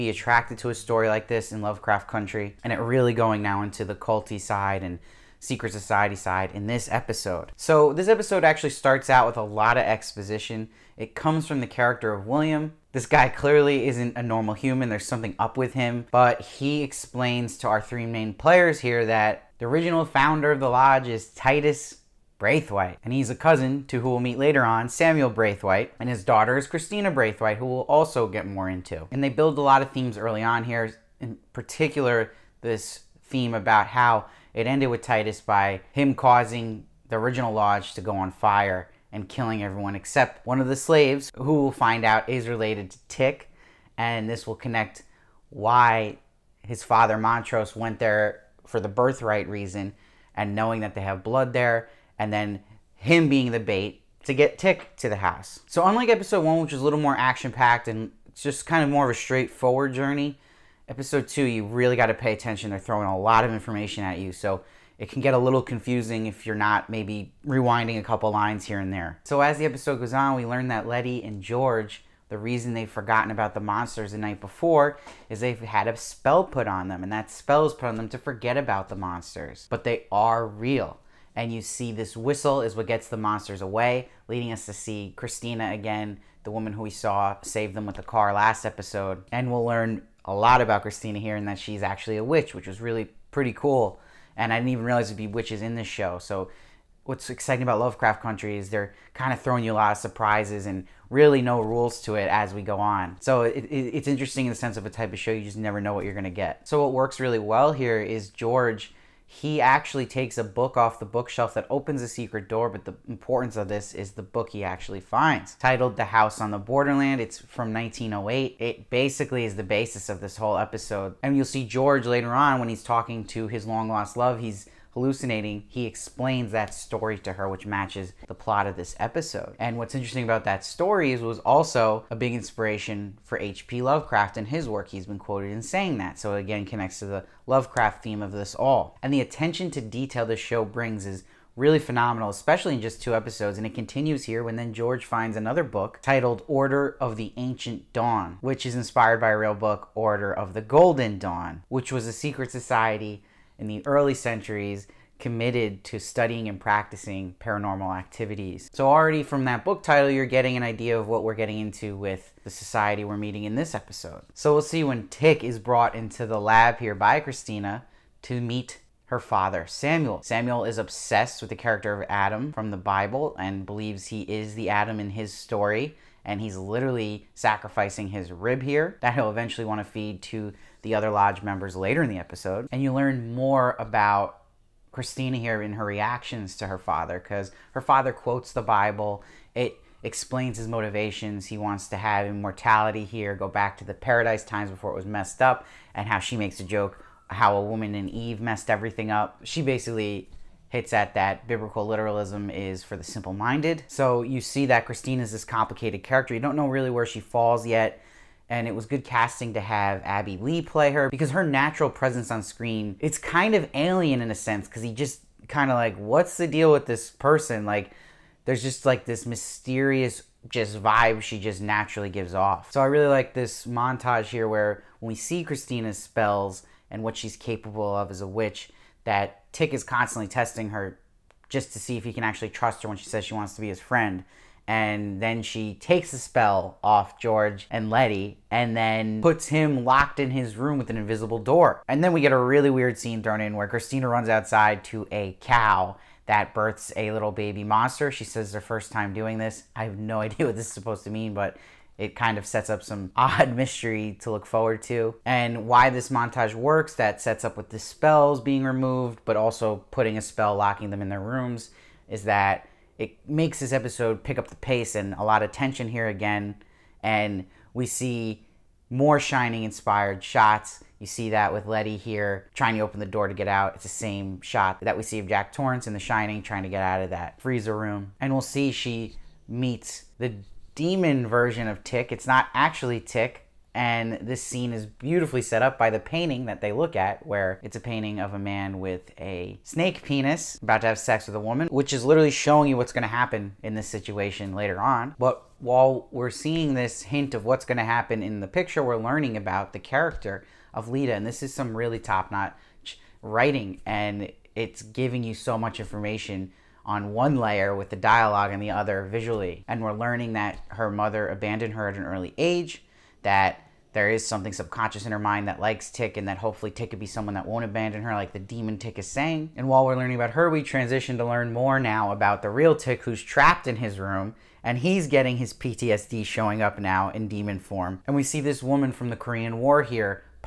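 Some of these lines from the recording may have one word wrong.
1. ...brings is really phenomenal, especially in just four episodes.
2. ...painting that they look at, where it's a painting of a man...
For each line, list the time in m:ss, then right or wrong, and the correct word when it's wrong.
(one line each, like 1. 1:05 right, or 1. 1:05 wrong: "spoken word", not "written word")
1. 2:20 wrong: "two", not "four"
2. 4:45 right.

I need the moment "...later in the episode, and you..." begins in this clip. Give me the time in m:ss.
3:01.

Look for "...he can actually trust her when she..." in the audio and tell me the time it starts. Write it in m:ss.
3:52.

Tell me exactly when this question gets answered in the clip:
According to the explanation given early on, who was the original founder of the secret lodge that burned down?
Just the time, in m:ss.
0:21.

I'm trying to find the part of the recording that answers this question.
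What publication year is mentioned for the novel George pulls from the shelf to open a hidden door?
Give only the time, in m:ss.
1:57.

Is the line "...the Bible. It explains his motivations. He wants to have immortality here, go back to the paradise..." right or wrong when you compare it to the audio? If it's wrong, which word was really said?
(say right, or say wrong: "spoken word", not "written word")
right.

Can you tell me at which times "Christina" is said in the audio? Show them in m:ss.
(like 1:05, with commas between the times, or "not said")
0:26, 1:25, 1:30, 2:47, 3:04, 3:24, 3:45, 4:03.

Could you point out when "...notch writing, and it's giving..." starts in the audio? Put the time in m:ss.
5:02.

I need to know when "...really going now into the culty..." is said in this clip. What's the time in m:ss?
0:02.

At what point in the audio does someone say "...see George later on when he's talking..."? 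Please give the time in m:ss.
2:01.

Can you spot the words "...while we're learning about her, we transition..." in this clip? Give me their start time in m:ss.
5:19.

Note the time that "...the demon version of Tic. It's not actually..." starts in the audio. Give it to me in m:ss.
4:40.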